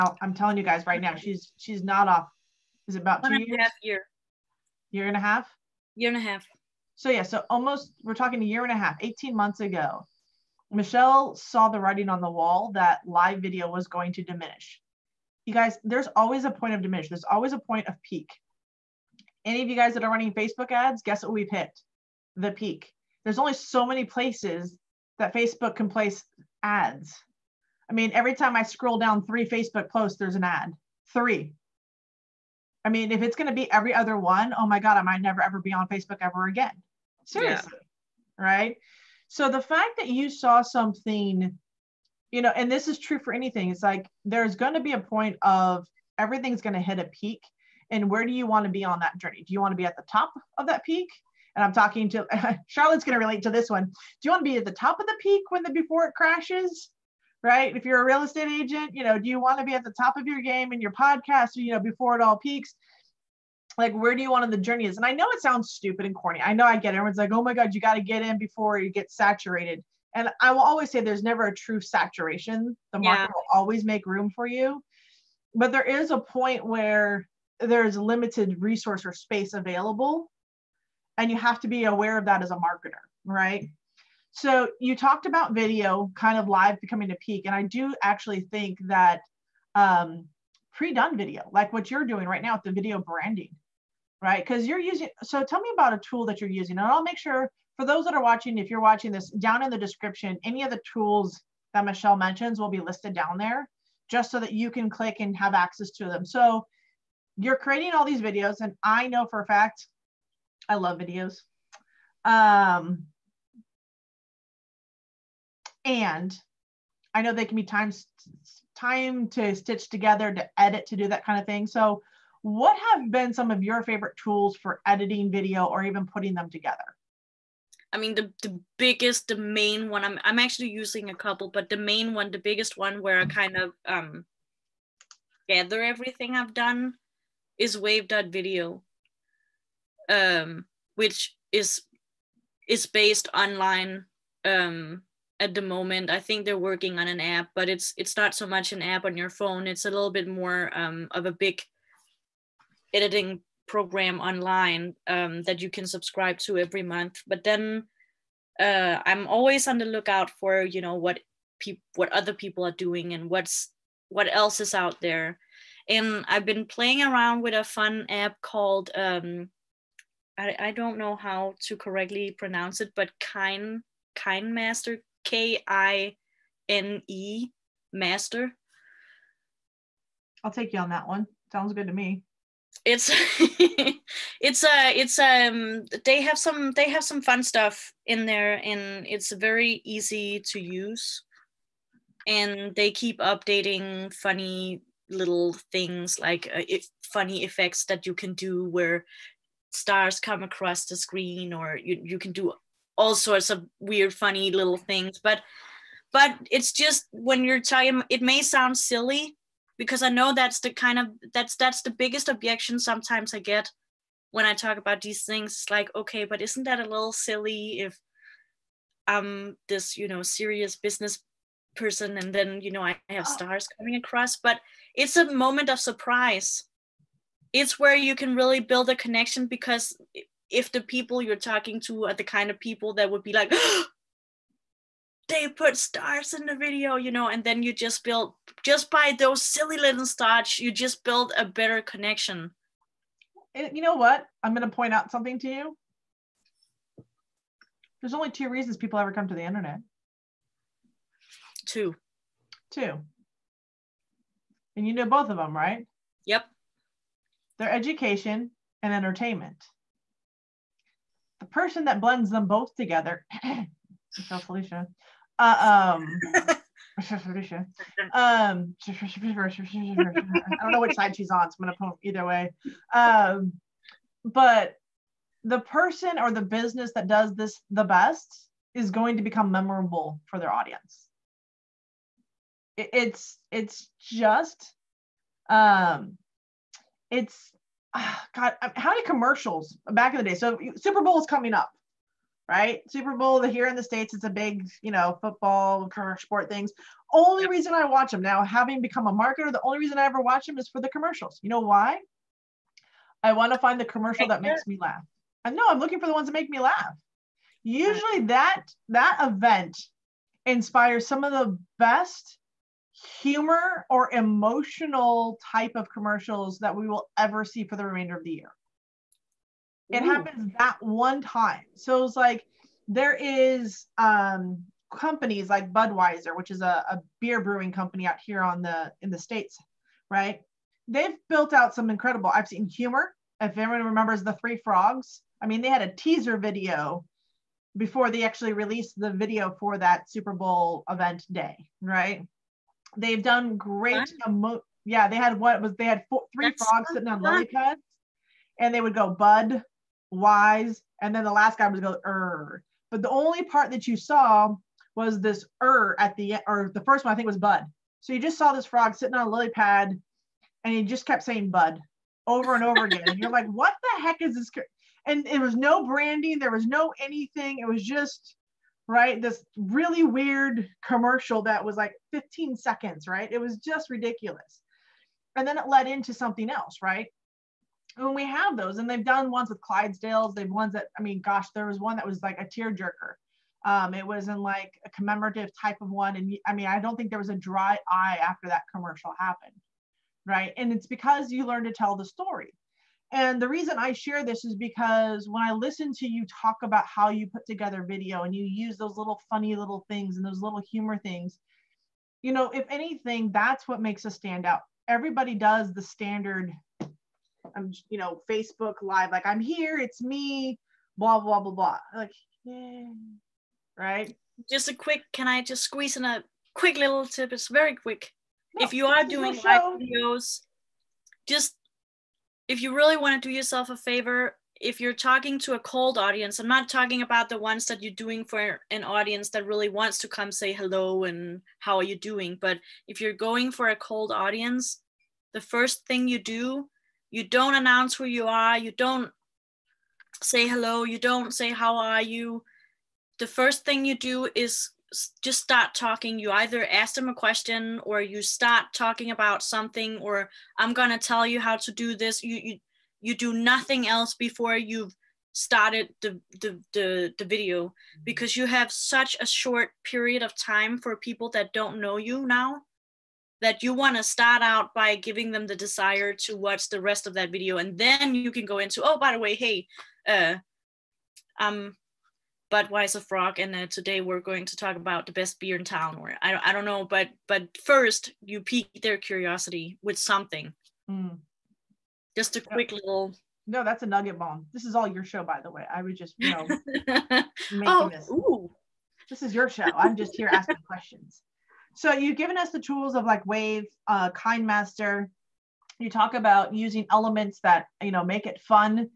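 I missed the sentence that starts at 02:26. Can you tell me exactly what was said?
I think they're working on an app, but it's, it's not so much an app on your phone.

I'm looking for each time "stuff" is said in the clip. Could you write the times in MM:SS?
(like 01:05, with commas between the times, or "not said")
03:07.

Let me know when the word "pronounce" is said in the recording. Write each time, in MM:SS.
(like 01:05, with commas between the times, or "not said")
02:52.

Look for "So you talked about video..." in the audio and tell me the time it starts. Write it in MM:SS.
01:24.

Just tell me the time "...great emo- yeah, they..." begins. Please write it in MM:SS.
05:43.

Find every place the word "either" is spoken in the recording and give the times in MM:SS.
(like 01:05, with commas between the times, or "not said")
04:32, 07:26.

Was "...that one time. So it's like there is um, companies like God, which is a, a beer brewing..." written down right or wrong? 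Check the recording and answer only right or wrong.
wrong.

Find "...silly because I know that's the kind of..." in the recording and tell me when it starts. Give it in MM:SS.
03:28.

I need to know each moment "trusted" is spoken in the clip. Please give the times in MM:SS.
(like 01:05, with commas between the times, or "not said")
not said.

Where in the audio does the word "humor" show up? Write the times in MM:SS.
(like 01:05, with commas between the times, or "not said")
05:13, 05:32, 06:40.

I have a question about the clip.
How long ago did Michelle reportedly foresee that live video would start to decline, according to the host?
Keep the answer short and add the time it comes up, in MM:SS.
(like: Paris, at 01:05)
18 months, at 00:08.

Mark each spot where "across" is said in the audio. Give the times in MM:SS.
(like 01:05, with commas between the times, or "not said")
03:20, 03:43.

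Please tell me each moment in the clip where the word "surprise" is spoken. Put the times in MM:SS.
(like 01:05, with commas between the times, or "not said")
03:45.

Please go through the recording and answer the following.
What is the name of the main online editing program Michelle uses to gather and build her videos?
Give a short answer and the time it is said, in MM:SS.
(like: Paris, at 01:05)
wave.video, at 02:17.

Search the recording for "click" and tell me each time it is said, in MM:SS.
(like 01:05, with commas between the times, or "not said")
01:44.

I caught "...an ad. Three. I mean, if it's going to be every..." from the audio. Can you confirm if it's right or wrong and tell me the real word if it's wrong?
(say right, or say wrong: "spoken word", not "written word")
right.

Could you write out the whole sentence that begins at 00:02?
Is it about one two years?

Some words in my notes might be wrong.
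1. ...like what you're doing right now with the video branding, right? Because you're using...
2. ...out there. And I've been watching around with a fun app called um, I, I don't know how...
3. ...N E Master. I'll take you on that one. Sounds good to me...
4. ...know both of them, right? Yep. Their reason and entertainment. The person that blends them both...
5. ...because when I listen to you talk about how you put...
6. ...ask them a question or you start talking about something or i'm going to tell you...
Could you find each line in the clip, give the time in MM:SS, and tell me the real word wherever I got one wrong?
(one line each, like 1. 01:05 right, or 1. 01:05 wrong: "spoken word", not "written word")
1. 01:31 right
2. 02:44 wrong: "playing", not "watching"
3. 02:56 right
4. 04:14 wrong: "education", not "reason"
5. 06:34 right
6. 07:26 right.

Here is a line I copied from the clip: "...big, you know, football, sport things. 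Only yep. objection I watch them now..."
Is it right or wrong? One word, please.
wrong.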